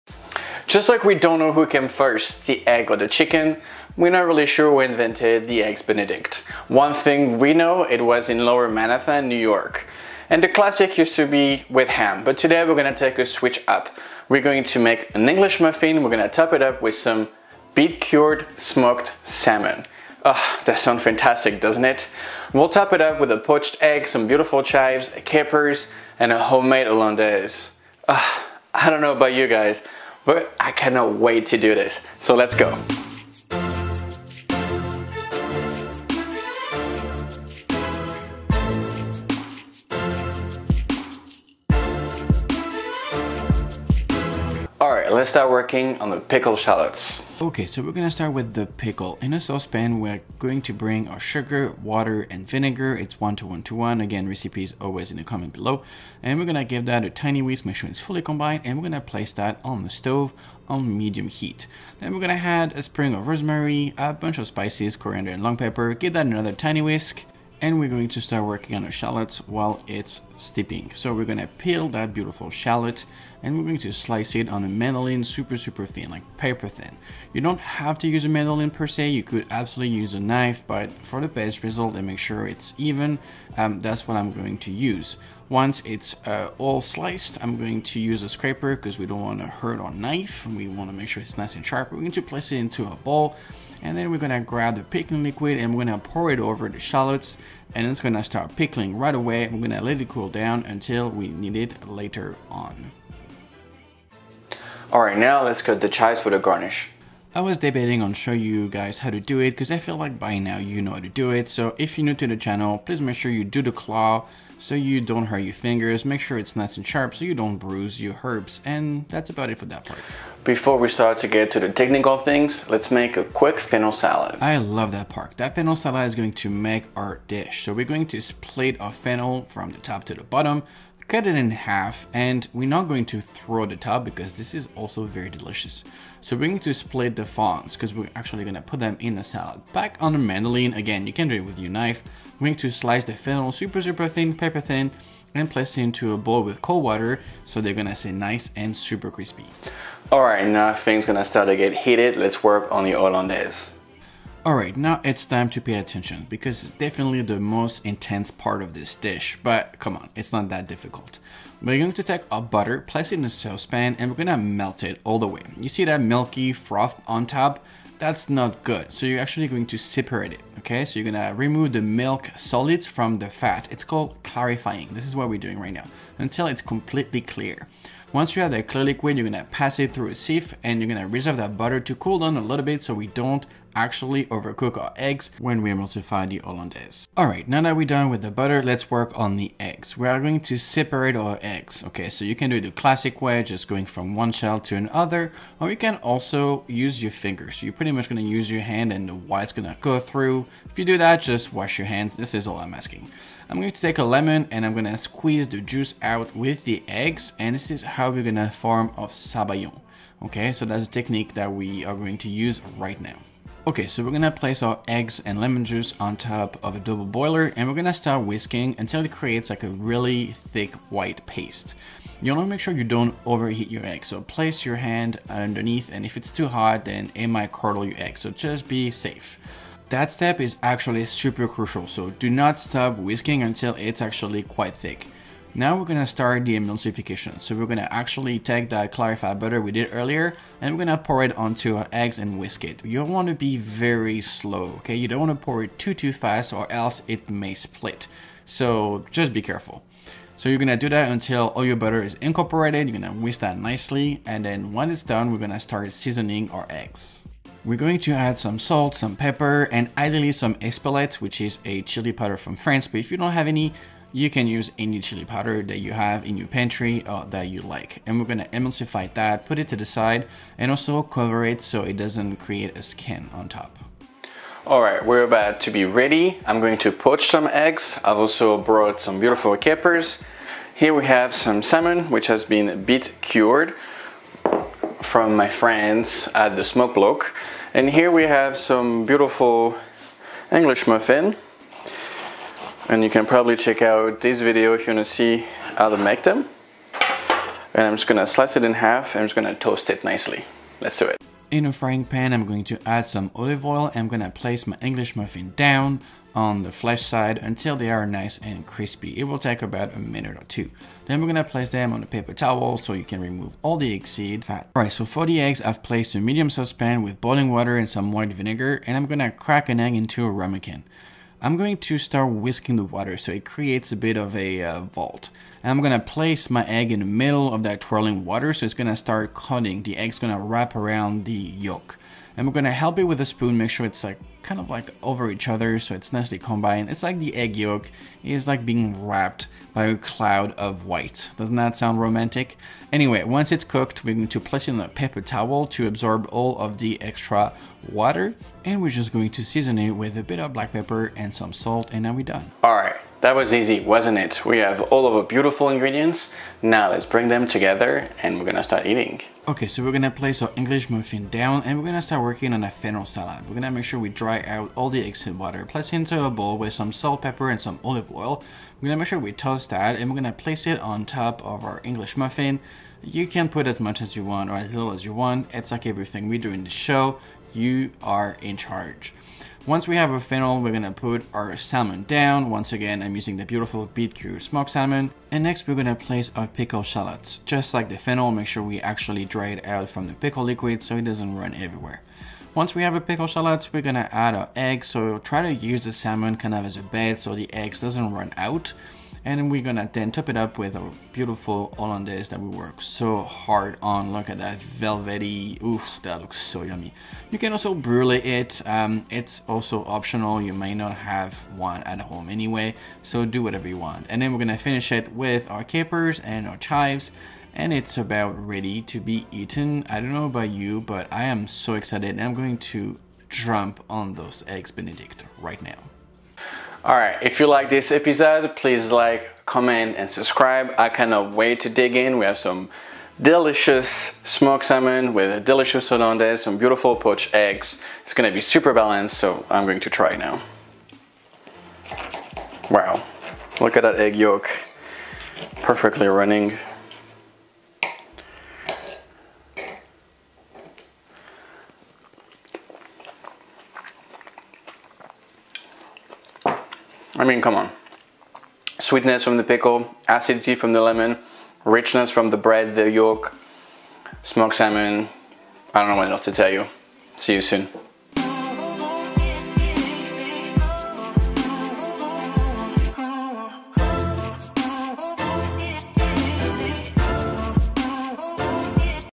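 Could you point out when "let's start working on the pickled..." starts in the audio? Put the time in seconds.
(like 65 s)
45 s.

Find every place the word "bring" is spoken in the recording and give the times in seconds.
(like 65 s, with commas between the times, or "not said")
50 s, 357 s.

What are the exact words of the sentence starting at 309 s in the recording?
It will take about a minute or two.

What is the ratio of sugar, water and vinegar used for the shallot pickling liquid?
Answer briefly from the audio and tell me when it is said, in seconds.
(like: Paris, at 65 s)
1 to 1 to 1, at 53 s.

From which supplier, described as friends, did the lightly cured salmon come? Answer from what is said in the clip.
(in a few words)
the Smoke Block.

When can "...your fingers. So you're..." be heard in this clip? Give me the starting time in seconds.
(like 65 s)
197 s.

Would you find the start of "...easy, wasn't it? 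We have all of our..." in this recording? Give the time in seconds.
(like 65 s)
353 s.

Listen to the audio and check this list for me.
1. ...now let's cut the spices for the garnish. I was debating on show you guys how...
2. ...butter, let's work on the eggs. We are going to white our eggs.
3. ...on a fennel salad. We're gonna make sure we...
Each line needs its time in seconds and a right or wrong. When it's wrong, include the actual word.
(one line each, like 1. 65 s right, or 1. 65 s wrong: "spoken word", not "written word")
1. 105 s wrong: "chives", not "spices"
2. 188 s wrong: "separate", not "white"
3. 362 s right.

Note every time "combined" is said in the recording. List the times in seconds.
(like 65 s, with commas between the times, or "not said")
58 s, 336 s.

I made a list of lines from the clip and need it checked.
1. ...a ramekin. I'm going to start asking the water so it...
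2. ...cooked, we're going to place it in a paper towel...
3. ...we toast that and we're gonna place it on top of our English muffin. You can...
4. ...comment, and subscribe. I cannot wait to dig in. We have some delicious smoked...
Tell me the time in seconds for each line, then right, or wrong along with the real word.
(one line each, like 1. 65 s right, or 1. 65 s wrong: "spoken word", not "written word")
1. 320 s wrong: "whisking", not "asking"
2. 343 s right
3. 369 s right
4. 429 s right.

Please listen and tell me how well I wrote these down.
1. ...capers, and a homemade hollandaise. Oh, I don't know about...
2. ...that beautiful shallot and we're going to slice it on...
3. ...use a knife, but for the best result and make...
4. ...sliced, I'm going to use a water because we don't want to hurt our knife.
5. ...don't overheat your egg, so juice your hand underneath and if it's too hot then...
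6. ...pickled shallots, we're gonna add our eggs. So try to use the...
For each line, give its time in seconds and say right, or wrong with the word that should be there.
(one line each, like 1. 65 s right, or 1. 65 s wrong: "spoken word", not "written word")
1. 25 s right
2. 71 s right
3. 79 s right
4. 86 s wrong: "scraper", not "water"
5. 222 s wrong: "place", not "juice"
6. 392 s right.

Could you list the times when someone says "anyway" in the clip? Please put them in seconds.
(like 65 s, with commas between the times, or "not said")
342 s, 412 s.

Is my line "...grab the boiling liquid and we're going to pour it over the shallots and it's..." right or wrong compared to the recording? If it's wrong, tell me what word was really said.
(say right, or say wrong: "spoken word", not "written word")
wrong: "pickling", not "boiling".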